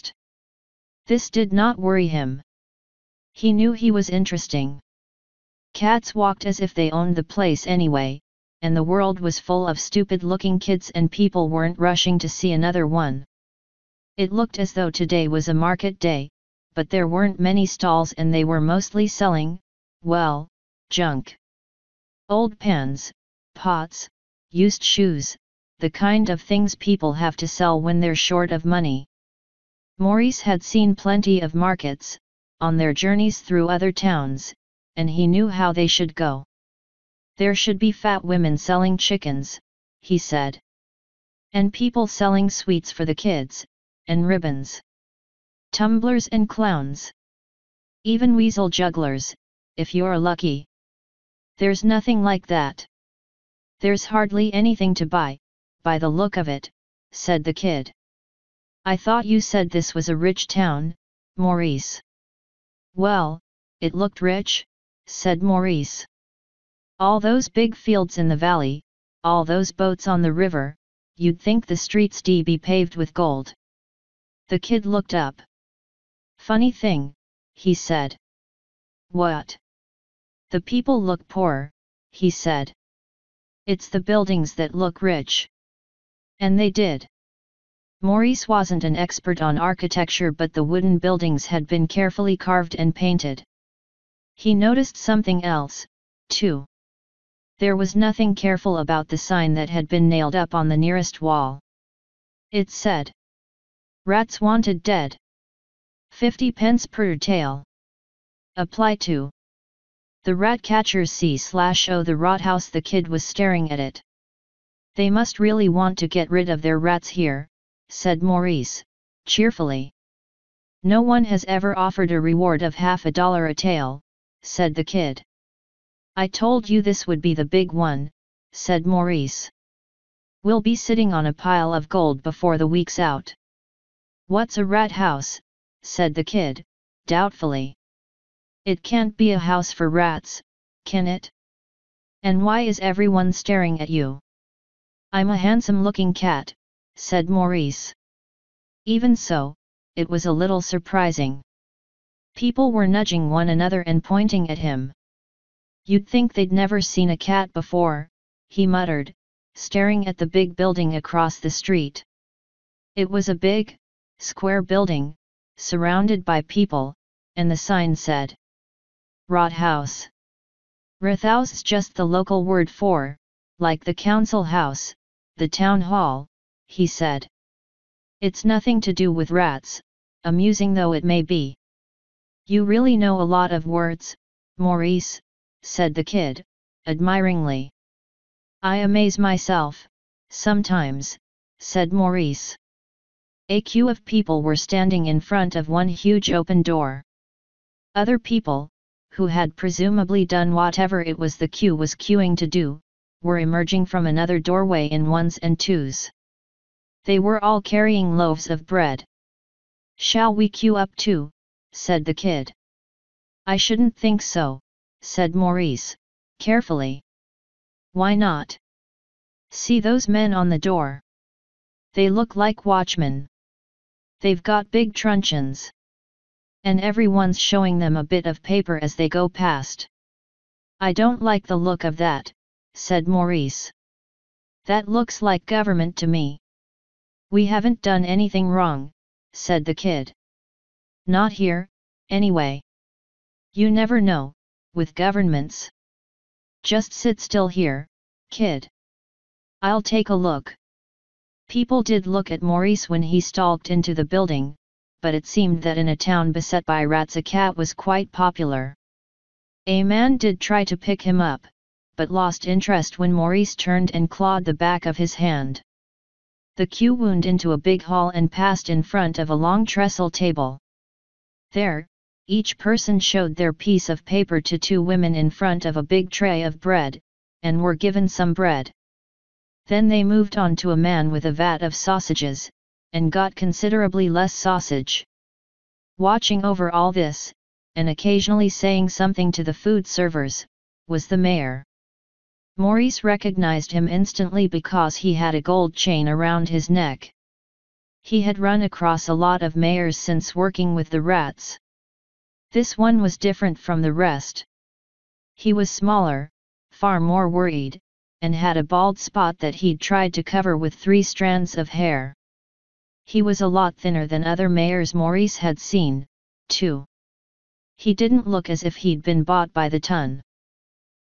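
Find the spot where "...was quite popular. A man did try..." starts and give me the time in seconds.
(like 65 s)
257 s.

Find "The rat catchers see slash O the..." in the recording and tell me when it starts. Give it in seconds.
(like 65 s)
110 s.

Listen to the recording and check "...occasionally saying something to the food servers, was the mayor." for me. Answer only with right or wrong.
right.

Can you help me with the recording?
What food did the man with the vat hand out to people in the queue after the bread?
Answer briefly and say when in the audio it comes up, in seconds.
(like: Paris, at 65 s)
sausages, at 281 s.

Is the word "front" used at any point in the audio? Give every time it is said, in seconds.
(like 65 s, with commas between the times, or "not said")
195 s, 268 s, 275 s.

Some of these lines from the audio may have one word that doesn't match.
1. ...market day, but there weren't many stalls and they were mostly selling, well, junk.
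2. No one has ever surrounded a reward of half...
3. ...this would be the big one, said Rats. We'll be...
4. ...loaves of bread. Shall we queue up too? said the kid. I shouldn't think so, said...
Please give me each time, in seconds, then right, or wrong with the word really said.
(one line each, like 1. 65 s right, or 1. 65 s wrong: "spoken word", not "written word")
1. 15 s right
2. 120 s wrong: "offered", not "surrounded"
3. 126 s wrong: "Maurice", not "Rats"
4. 208 s right.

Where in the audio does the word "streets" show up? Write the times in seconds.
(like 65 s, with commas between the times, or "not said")
71 s, 161 s.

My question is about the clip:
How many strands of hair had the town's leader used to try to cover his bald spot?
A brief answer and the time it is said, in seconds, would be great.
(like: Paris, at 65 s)
3, at 310 s.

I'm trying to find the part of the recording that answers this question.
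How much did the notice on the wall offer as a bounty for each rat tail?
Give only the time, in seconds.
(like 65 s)
106 s.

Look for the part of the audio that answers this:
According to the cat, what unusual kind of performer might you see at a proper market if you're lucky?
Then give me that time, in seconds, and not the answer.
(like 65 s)
48 s.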